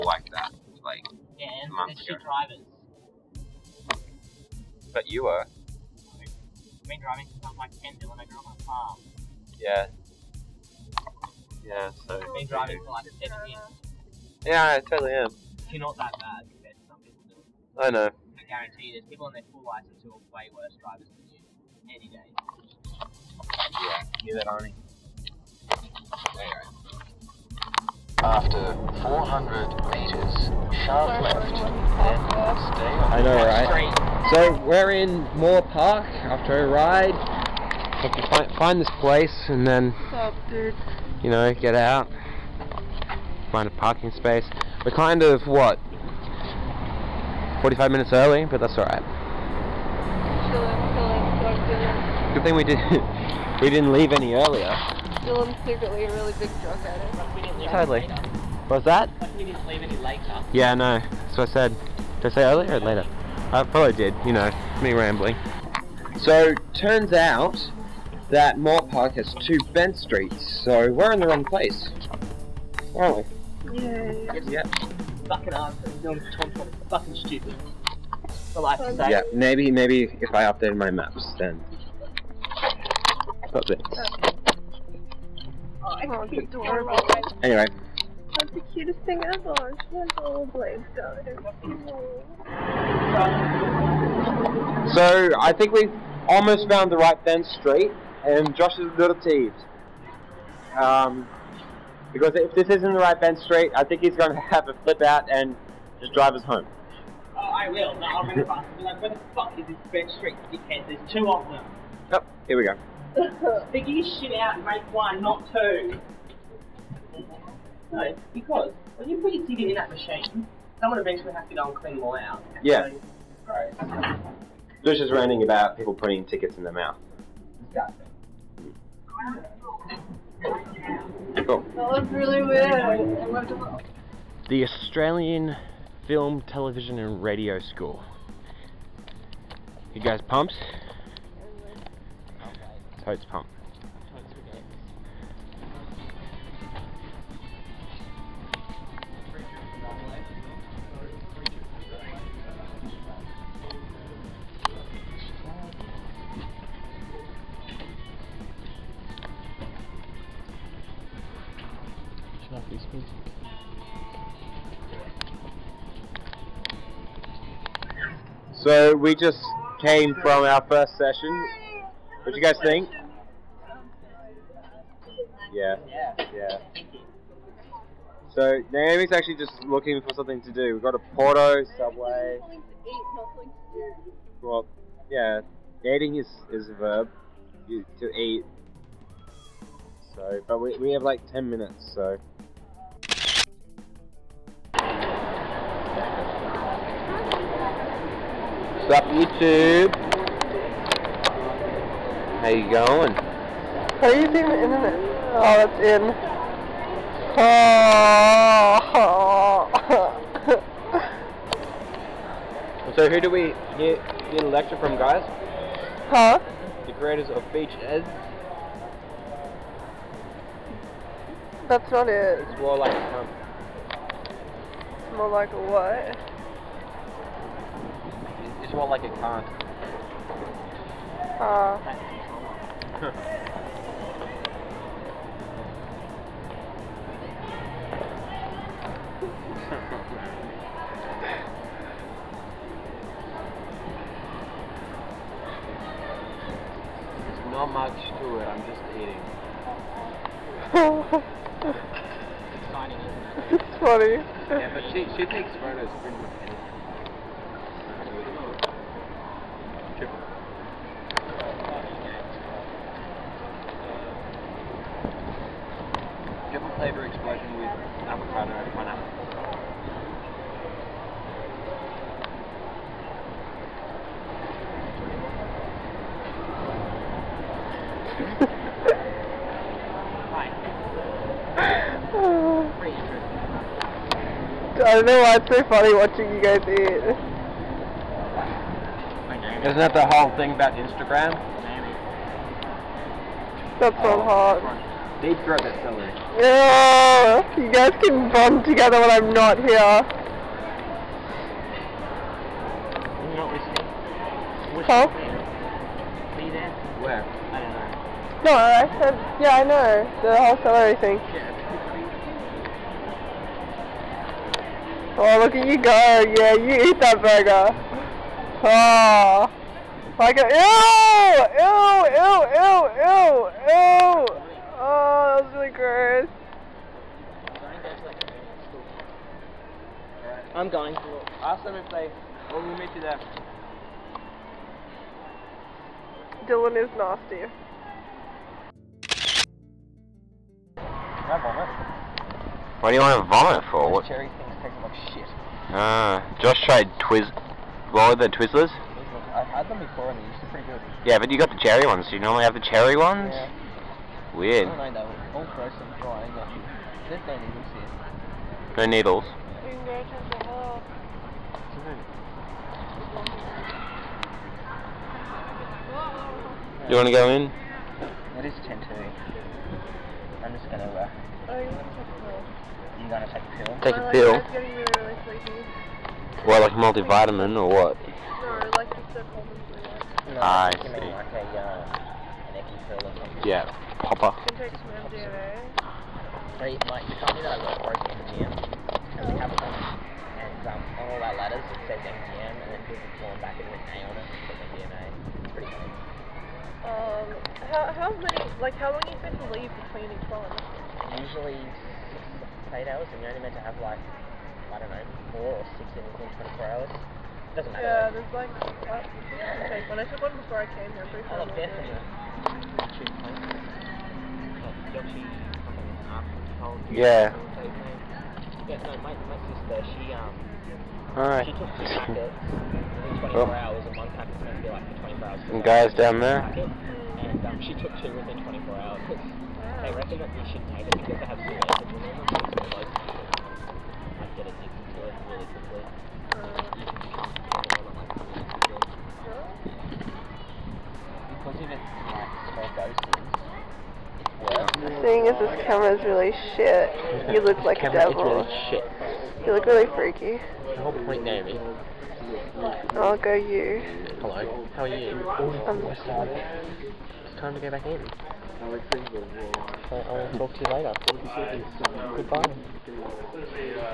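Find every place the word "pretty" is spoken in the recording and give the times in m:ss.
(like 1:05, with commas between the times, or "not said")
4:16, 5:50, 6:35, 6:51.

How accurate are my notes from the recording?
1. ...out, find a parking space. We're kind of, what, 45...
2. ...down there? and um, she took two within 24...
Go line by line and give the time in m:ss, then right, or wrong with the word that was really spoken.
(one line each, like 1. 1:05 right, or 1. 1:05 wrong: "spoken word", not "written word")
1. 0:41 right
2. 7:05 right.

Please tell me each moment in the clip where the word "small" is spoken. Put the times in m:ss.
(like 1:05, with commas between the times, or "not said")
7:22.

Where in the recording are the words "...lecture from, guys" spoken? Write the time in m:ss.
3:34.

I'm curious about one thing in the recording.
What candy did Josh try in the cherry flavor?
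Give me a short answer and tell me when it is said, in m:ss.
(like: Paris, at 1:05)
Twizzlers, at 5:48.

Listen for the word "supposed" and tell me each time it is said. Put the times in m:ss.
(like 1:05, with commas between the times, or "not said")
6:39.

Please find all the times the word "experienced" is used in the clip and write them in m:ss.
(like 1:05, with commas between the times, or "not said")
not said.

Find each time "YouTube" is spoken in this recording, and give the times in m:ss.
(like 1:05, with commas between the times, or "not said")
3:19.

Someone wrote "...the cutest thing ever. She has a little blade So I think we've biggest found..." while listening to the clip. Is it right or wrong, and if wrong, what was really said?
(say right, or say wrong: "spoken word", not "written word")
wrong: "almost", not "biggest".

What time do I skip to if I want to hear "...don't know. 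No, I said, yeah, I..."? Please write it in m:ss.
5:07.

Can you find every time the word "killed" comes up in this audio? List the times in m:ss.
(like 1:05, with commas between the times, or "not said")
not said.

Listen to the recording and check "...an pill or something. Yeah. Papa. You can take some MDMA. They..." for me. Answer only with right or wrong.
right.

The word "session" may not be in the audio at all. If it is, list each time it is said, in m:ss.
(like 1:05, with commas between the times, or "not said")
2:50.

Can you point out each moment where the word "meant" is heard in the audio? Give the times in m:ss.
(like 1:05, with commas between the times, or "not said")
6:43.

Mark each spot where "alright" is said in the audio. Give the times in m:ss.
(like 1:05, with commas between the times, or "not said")
0:48, 7:01.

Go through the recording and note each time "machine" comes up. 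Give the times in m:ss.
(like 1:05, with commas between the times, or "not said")
1:59.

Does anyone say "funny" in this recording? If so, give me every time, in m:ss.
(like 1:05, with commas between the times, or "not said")
4:13, 4:45, 6:35.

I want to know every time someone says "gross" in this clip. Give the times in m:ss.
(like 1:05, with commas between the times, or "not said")
2:04, 5:25.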